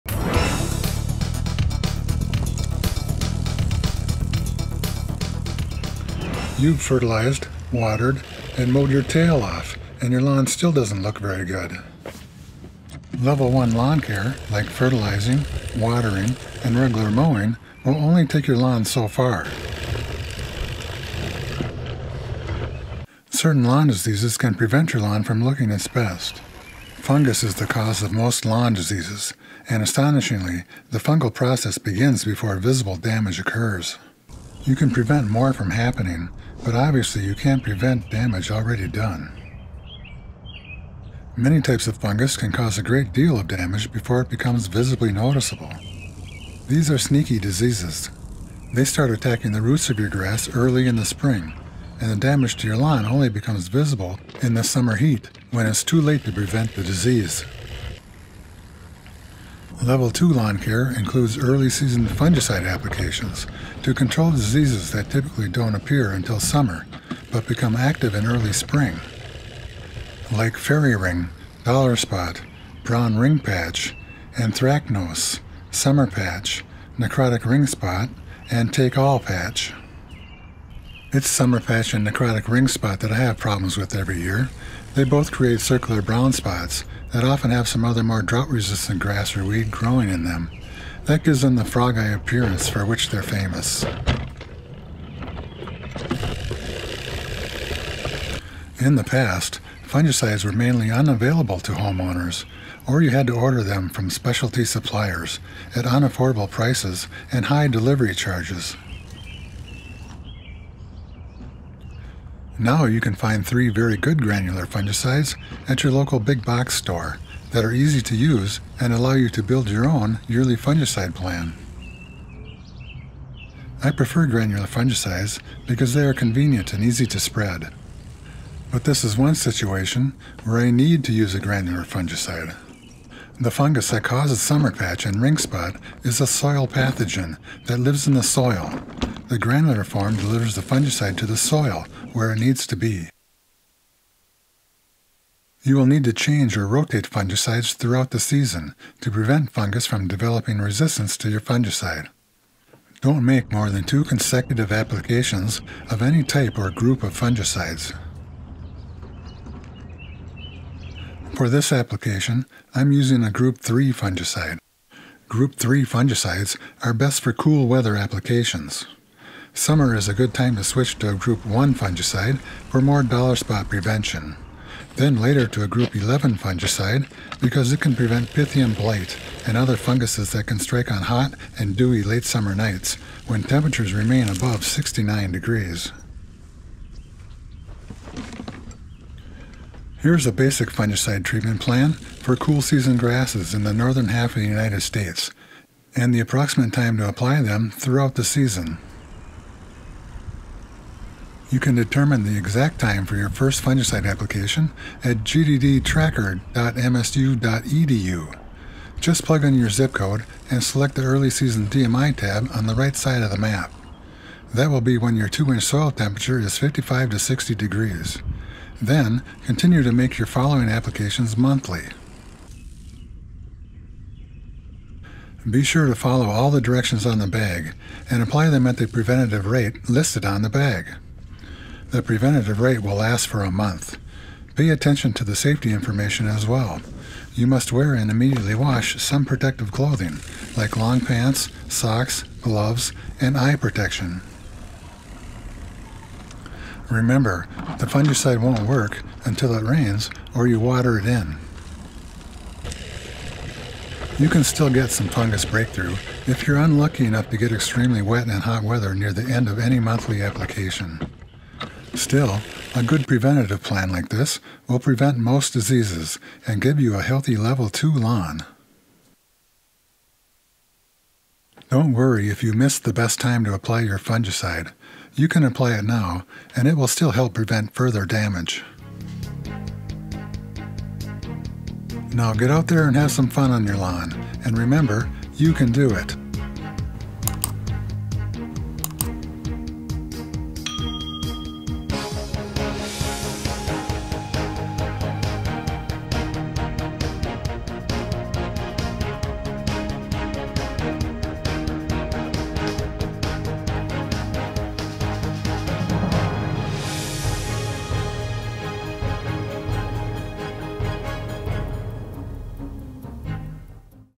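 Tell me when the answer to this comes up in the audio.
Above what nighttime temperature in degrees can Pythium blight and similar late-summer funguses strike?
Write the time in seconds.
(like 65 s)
184 s.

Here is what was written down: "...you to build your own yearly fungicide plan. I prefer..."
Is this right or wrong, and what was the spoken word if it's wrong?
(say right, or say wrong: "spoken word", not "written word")
right.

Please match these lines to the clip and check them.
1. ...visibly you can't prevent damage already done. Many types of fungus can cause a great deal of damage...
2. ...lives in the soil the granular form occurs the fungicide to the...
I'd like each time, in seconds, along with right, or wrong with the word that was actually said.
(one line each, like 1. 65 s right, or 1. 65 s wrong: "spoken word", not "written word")
1. 36 s wrong: "obviously", not "visibly"
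2. 137 s wrong: "delivers", not "occurs".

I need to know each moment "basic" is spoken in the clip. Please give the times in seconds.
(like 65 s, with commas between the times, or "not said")
190 s.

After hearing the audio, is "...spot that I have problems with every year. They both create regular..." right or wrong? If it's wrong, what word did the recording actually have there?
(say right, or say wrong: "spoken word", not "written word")
wrong: "circular", not "regular".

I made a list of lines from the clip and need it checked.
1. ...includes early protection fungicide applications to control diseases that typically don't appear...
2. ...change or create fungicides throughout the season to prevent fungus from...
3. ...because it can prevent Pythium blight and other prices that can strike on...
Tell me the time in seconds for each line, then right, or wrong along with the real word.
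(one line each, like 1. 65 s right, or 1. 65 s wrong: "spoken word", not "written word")
1. 60 s wrong: "season", not "protection"
2. 146 s wrong: "rotate", not "create"
3. 177 s wrong: "funguses", not "prices".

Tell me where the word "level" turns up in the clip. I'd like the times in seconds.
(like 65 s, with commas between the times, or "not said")
13 s, 59 s, 267 s.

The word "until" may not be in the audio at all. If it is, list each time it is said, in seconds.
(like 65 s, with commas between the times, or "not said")
66 s, 249 s.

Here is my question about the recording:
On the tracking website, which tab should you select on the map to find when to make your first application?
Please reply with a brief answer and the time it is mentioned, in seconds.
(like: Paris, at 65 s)
Early Season DMI, at 211 s.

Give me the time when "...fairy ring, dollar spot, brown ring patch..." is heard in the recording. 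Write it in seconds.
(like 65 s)
70 s.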